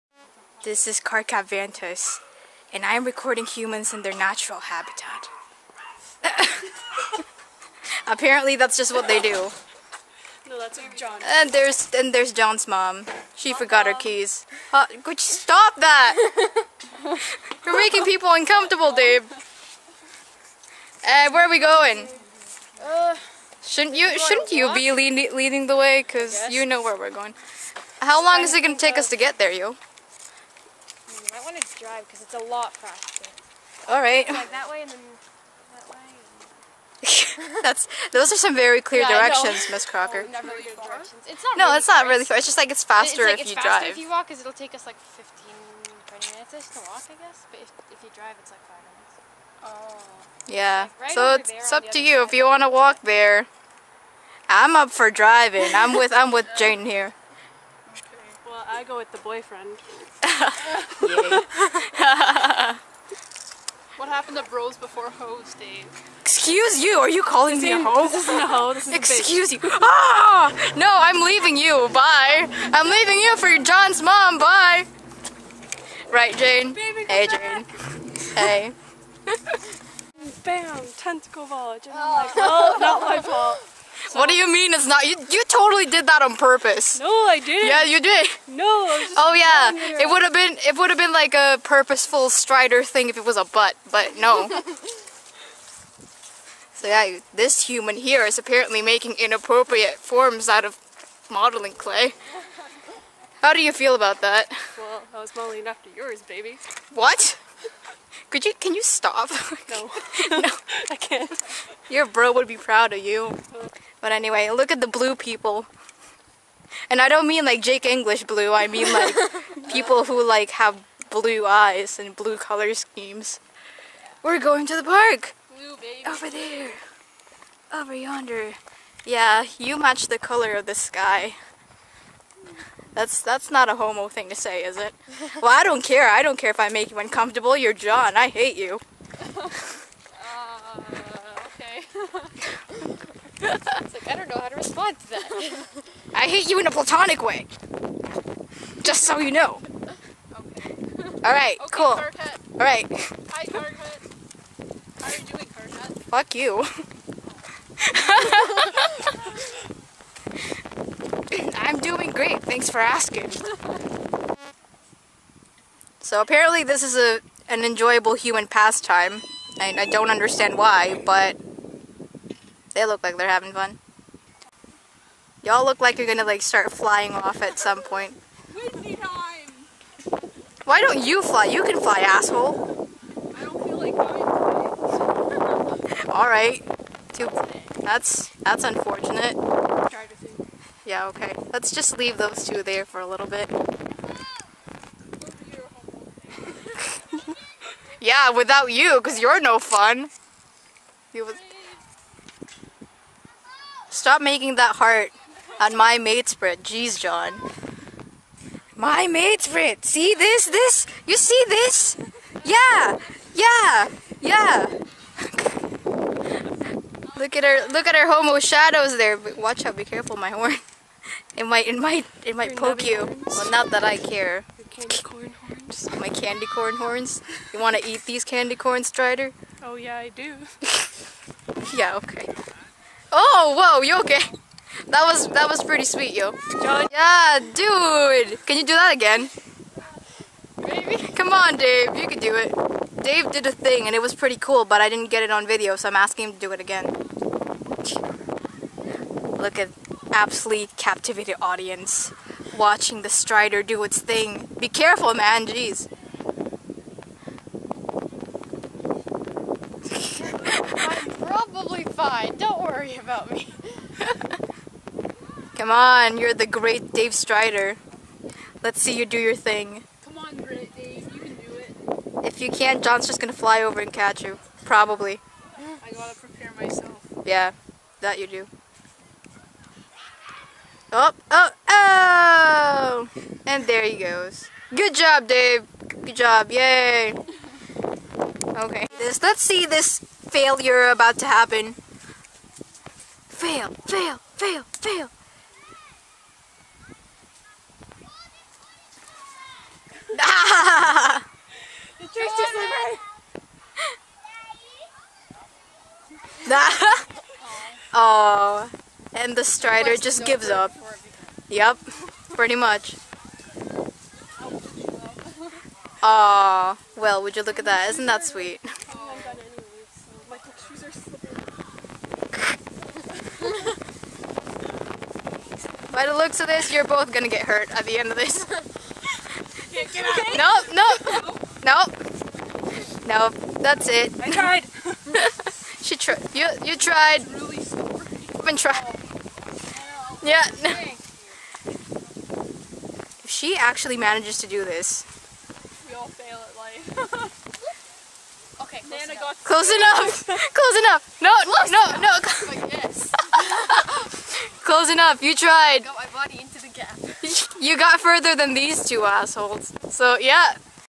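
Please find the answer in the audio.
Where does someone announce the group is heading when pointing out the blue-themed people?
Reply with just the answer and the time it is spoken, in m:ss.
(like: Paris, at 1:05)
The park, at 2:04.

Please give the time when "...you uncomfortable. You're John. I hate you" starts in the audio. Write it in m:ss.
2:16.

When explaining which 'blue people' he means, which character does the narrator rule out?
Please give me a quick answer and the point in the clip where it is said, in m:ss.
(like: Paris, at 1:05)
Jake English, at 1:57.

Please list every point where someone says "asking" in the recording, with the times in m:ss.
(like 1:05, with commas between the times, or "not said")
2:42, 4:05.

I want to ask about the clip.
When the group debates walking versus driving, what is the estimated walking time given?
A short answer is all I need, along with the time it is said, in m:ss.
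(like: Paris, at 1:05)
15-20 minutes, at 0:44.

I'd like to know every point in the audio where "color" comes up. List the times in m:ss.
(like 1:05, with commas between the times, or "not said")
2:02, 2:10.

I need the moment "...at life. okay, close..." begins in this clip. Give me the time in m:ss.
5:46.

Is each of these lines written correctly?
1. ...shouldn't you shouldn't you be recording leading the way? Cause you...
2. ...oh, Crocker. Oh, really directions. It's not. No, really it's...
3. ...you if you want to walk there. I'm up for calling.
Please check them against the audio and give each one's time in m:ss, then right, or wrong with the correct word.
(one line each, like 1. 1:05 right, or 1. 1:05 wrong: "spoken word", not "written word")
1. 0:23 wrong: "leading", not "recording"
2. 0:39 right
3. 0:52 wrong: "driving", not "calling".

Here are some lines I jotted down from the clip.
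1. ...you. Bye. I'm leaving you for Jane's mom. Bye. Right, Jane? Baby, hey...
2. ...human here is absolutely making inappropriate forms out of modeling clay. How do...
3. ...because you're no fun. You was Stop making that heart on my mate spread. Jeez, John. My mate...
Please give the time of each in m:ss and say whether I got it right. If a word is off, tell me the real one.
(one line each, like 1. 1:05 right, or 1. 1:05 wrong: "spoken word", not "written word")
1. 1:11 wrong: "John", not "Jane"
2. 1:37 wrong: "apparently", not "absolutely"
3. 3:19 right.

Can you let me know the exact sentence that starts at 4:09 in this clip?
Look at absolutely captivated audience watching the Strider do its thing.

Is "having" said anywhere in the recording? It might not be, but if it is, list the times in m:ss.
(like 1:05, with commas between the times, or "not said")
2:53.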